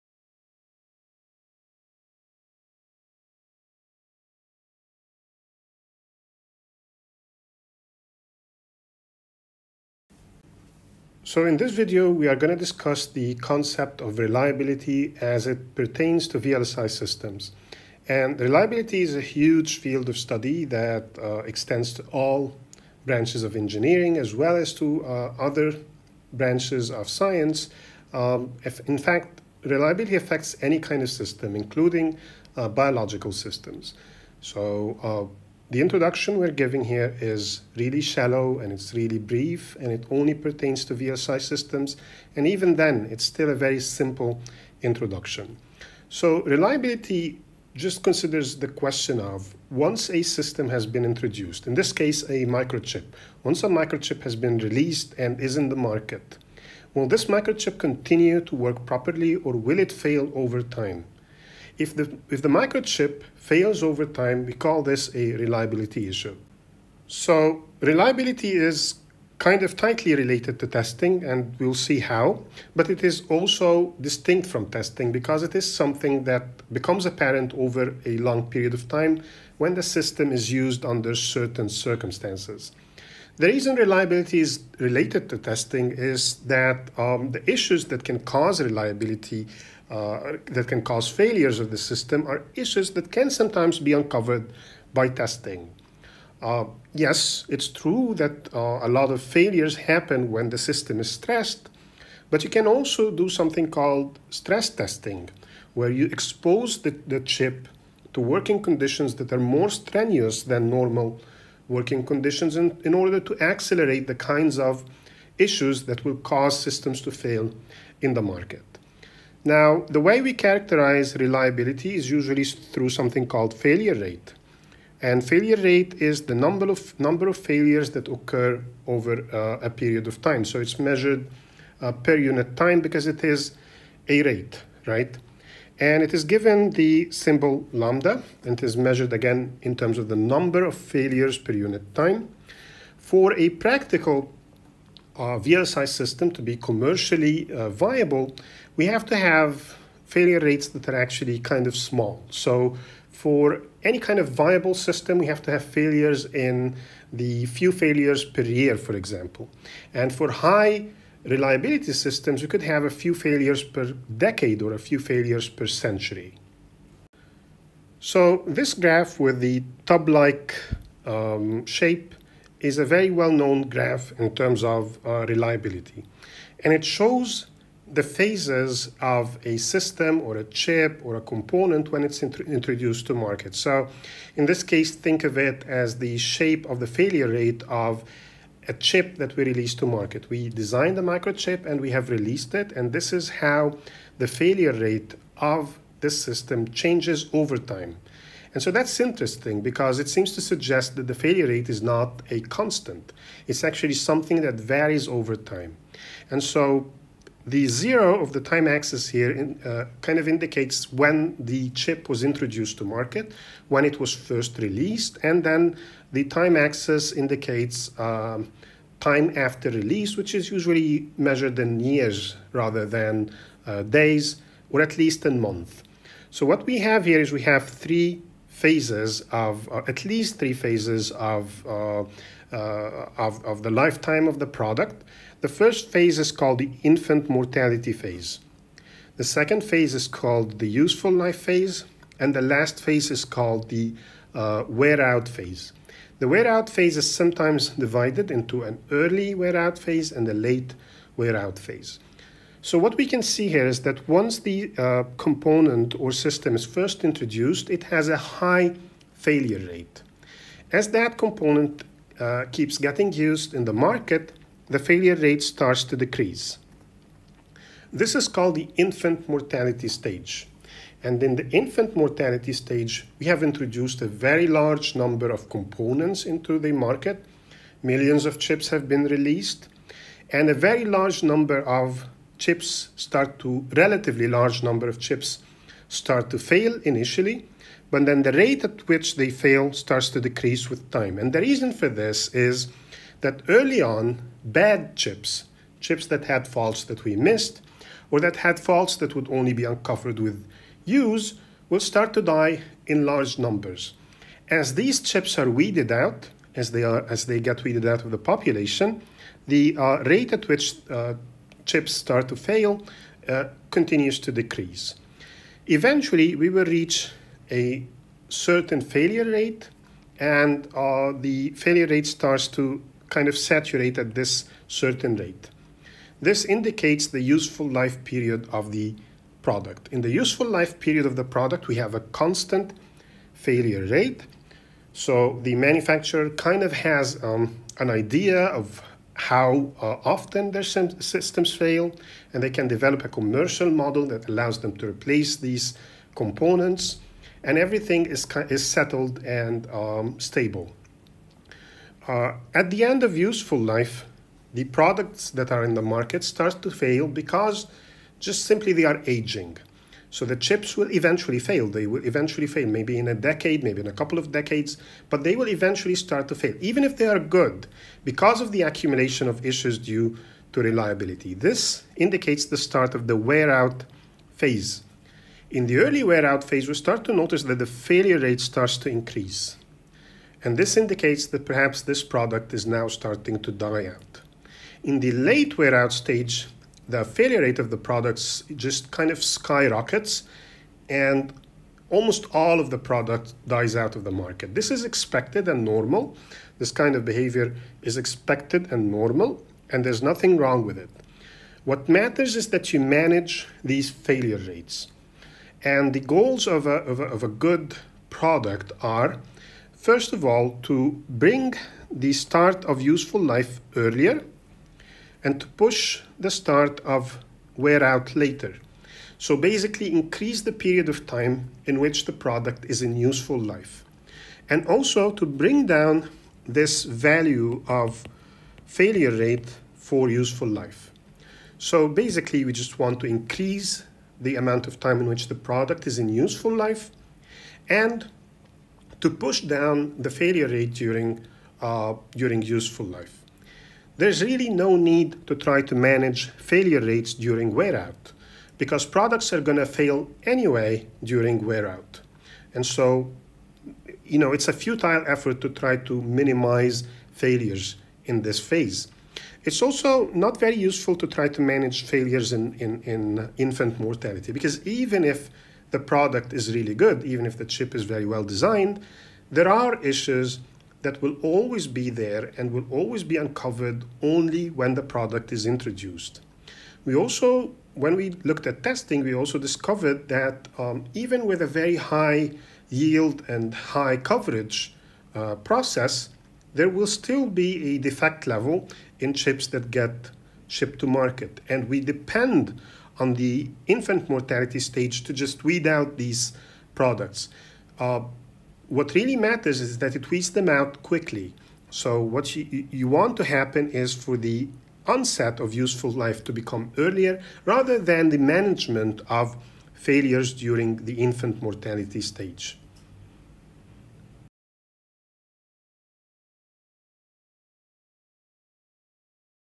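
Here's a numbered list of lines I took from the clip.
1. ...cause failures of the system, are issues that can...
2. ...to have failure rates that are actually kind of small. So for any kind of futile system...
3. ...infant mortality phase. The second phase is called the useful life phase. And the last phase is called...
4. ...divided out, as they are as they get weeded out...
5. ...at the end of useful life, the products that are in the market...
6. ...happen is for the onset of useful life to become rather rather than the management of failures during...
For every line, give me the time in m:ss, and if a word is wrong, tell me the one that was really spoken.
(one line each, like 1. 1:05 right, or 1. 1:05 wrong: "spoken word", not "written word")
1. 1:30 right
2. 2:29 wrong: "viable", not "futile"
3. 3:56 right
4. 5:05 wrong: "weeded", not "divided"
5. 5:52 right
6. 8:23 wrong: "earlier", not "rather".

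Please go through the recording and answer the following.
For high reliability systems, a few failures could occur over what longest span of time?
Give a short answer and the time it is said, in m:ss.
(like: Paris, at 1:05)
century, at 2:45.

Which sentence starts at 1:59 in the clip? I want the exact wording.
Now, the way we characterize reliability is usually through something called failure rate.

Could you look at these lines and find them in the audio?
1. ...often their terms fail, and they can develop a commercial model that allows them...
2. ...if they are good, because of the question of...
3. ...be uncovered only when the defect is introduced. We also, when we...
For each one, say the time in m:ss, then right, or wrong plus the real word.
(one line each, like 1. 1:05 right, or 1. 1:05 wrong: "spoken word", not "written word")
1. 5:40 wrong: "systems", not "terms"
2. 6:06 wrong: "accumulation", not "question"
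3. 7:53 wrong: "product", not "defect".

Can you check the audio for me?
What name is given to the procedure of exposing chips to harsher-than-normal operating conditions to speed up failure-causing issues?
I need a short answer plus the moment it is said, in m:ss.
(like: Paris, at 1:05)
stress testing, at 1:44.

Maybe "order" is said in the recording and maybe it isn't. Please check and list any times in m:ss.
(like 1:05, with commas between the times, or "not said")
1:52.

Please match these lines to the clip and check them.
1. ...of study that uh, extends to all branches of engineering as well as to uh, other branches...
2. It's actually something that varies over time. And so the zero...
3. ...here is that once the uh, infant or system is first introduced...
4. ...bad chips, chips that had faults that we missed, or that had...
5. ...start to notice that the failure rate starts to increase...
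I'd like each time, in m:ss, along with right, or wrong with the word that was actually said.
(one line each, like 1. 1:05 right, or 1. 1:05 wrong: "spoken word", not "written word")
1. 0:20 right
2. 3:23 right
3. 4:13 wrong: "component", not "infant"
4. 4:54 right
5. 6:16 right.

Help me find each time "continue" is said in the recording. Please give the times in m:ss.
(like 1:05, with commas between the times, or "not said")
0:57, 5:13.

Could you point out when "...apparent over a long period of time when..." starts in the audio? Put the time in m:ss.
1:17.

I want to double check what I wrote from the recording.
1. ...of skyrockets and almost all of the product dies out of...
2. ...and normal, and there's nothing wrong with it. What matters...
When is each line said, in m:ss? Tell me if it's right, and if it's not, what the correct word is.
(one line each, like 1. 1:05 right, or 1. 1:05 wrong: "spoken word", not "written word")
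1. 6:29 right
2. 6:38 right.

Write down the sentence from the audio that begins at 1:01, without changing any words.
If the, if the microchip fails over time, we call this a reliability issue.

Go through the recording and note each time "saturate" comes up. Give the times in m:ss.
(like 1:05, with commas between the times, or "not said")
5:23.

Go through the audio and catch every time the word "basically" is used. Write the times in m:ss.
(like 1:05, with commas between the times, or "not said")
6:59, 7:11.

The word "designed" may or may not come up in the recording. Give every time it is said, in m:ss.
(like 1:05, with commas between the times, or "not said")
3:10, 7:48.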